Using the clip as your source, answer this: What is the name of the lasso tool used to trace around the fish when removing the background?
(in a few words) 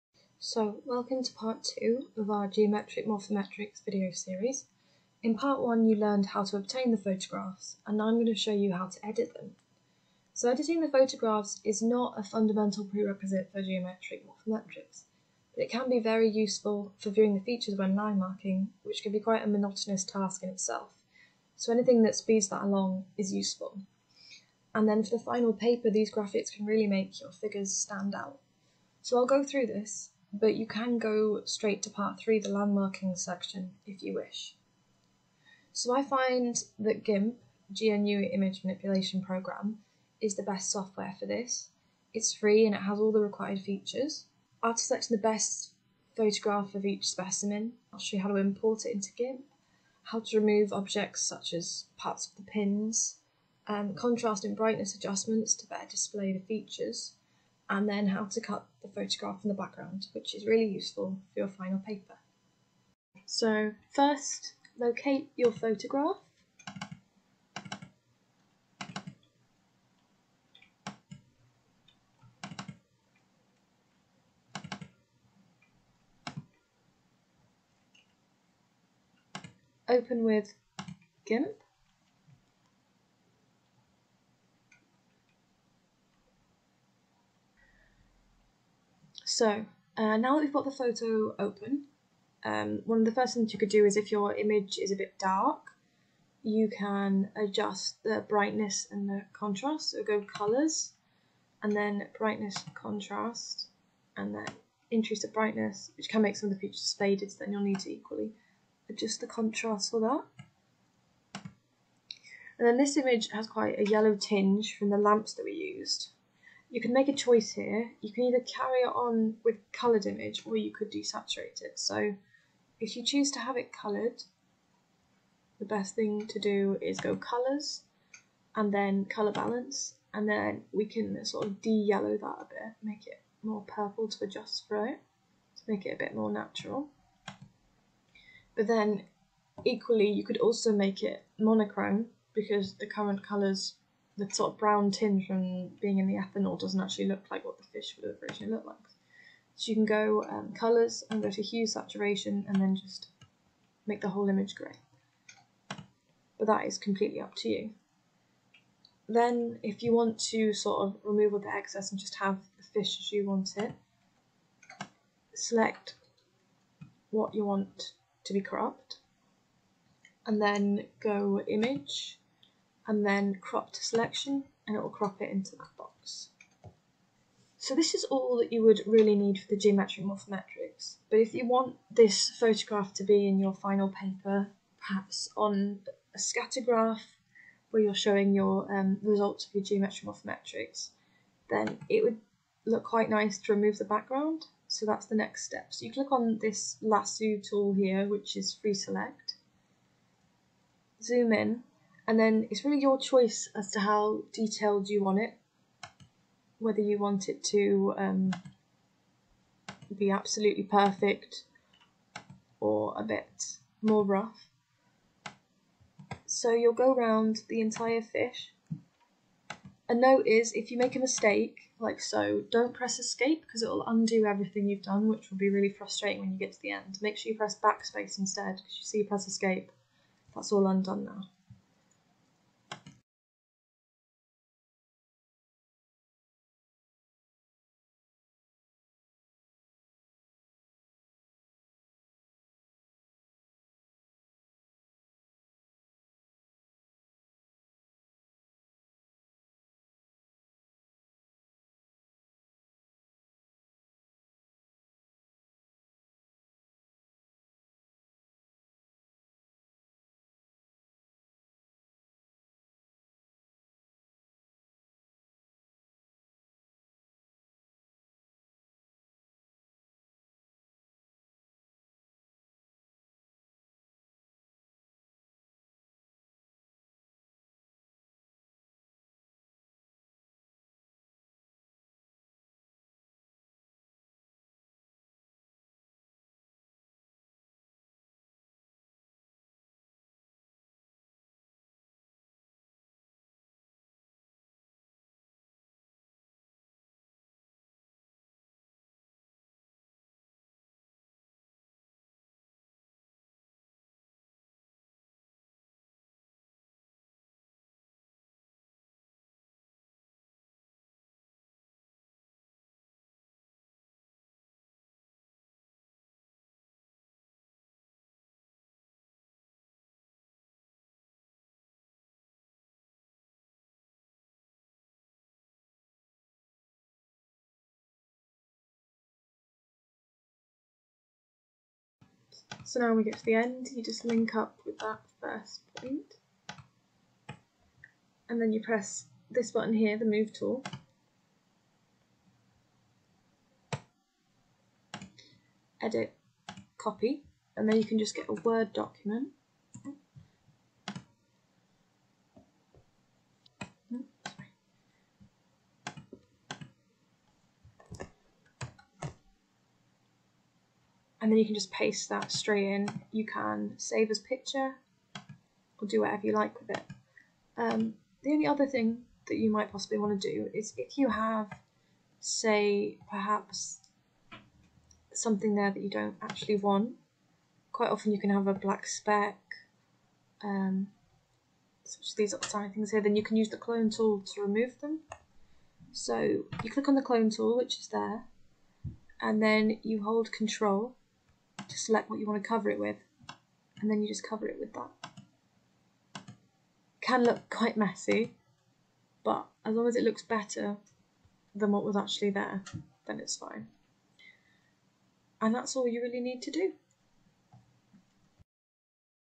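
free select.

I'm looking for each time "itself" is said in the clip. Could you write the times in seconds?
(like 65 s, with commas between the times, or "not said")
20 s.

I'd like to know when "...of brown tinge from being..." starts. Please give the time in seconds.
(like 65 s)
144 s.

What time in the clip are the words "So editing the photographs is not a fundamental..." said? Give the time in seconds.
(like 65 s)
10 s.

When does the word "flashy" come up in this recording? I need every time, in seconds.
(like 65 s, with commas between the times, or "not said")
not said.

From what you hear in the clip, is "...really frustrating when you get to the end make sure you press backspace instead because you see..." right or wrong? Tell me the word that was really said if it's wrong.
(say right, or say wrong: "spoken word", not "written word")
right.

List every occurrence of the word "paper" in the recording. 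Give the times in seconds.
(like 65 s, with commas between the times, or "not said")
25 s, 61 s, 183 s.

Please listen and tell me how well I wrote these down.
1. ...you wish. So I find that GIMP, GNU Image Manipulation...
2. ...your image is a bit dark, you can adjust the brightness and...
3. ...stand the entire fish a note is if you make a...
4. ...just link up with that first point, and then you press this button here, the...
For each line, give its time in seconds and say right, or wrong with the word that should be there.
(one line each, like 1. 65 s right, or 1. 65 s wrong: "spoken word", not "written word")
1. 34 s right
2. 94 s right
3. 216 s wrong: "round", not "stand"
4. 333 s right.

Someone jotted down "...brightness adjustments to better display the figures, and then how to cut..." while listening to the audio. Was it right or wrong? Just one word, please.
wrong.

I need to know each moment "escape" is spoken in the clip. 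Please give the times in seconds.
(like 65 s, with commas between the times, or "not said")
222 s, 229 s.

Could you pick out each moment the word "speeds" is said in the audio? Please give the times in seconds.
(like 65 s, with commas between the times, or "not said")
22 s.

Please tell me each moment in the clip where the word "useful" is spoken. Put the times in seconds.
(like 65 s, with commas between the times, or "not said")
16 s, 23 s, 60 s.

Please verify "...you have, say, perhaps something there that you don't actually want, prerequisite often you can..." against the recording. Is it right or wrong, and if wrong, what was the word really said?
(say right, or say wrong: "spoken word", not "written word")
wrong: "quite", not "prerequisite".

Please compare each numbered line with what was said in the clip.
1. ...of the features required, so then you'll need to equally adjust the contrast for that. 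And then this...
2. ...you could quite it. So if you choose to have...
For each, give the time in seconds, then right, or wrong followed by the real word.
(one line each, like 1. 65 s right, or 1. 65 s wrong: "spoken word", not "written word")
1. 106 s wrong: "faded", not "required"
2. 120 s wrong: "desaturate", not "quite".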